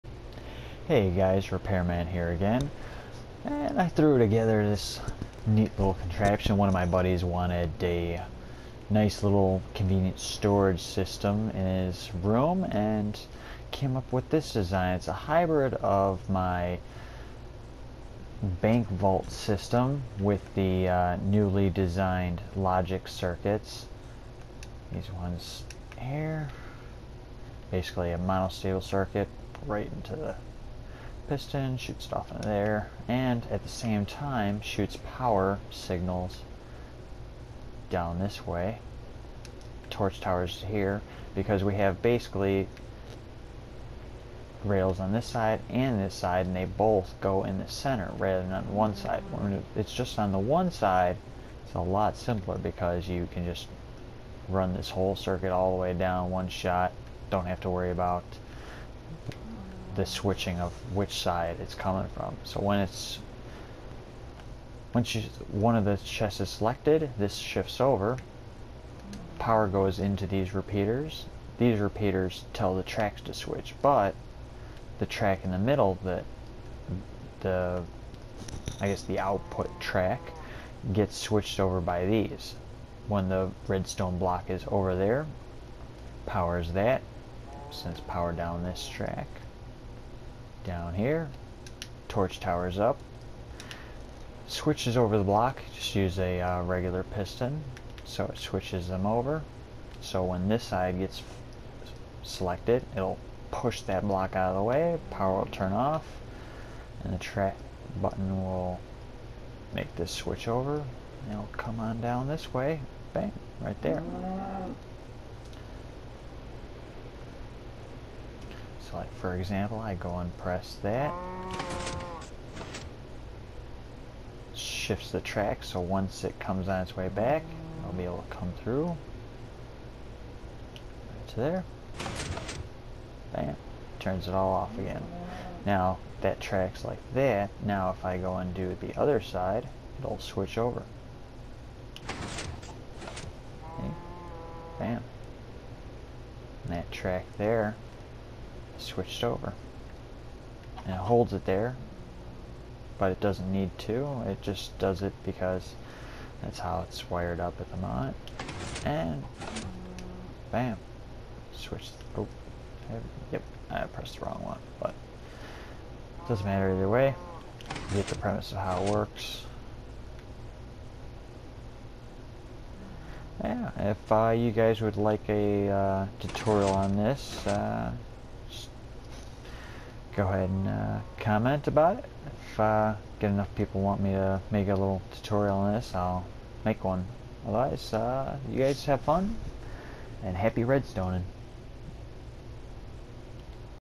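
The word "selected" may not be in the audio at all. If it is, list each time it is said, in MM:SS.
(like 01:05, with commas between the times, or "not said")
01:06, 01:42.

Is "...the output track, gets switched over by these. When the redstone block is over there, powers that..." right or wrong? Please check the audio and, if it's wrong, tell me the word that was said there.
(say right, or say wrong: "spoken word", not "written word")
right.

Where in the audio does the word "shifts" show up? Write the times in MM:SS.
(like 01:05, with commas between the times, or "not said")
01:07, 02:04.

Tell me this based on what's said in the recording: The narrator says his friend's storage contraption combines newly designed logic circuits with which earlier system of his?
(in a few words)
bank vault system.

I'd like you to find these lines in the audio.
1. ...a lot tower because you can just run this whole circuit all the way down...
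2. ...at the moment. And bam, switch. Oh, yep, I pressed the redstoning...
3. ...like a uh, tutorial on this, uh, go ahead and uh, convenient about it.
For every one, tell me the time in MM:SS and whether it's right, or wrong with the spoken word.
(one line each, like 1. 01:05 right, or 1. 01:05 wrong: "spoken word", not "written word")
1. 00:51 wrong: "simpler", not "tower"
2. 02:37 wrong: "wrong", not "redstoning"
3. 02:54 wrong: "comment", not "convenient".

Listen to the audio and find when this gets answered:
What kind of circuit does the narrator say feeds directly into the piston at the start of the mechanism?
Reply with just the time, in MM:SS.
00:28.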